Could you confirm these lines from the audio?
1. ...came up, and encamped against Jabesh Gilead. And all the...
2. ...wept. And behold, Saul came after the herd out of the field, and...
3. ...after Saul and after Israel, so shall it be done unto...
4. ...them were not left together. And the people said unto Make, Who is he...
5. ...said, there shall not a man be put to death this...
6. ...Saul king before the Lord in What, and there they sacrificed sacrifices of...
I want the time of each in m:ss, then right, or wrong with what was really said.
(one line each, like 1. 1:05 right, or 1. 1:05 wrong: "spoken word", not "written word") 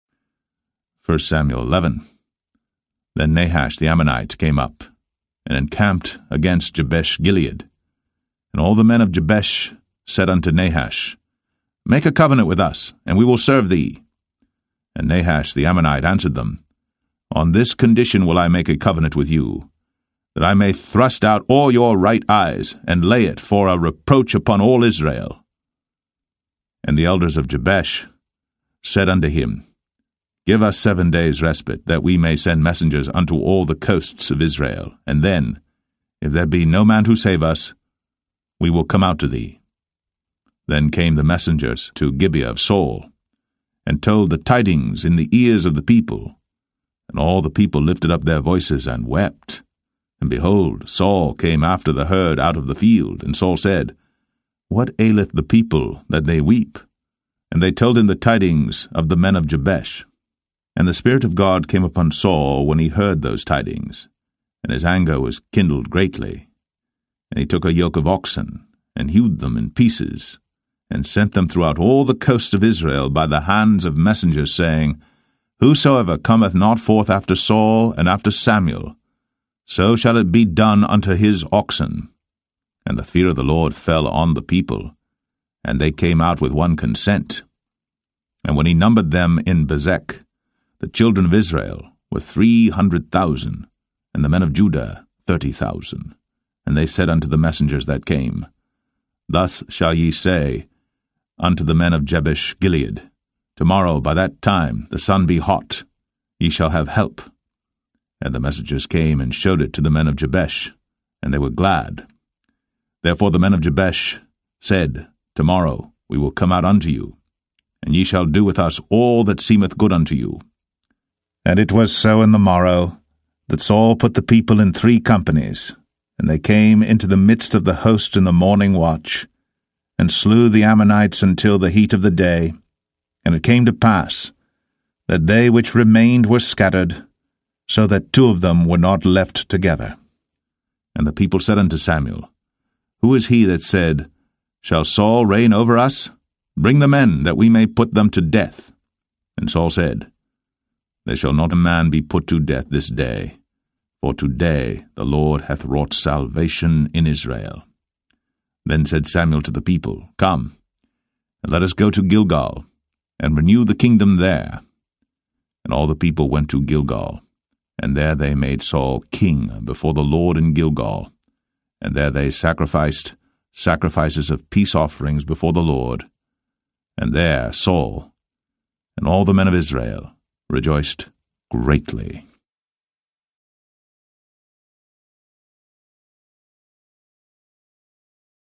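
1. 0:04 right
2. 0:49 right
3. 1:17 wrong: "Samuel", not "Israel"
4. 2:18 wrong: "Samuel", not "Make"
5. 2:29 right
6. 2:48 wrong: "Gilgal", not "What".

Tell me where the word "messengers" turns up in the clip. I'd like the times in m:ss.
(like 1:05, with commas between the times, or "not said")
0:32, 0:41, 1:13, 1:37, 1:48.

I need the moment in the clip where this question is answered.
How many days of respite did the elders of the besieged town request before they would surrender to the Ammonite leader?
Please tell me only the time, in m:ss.
0:30.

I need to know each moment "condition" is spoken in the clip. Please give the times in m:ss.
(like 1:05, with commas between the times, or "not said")
0:17.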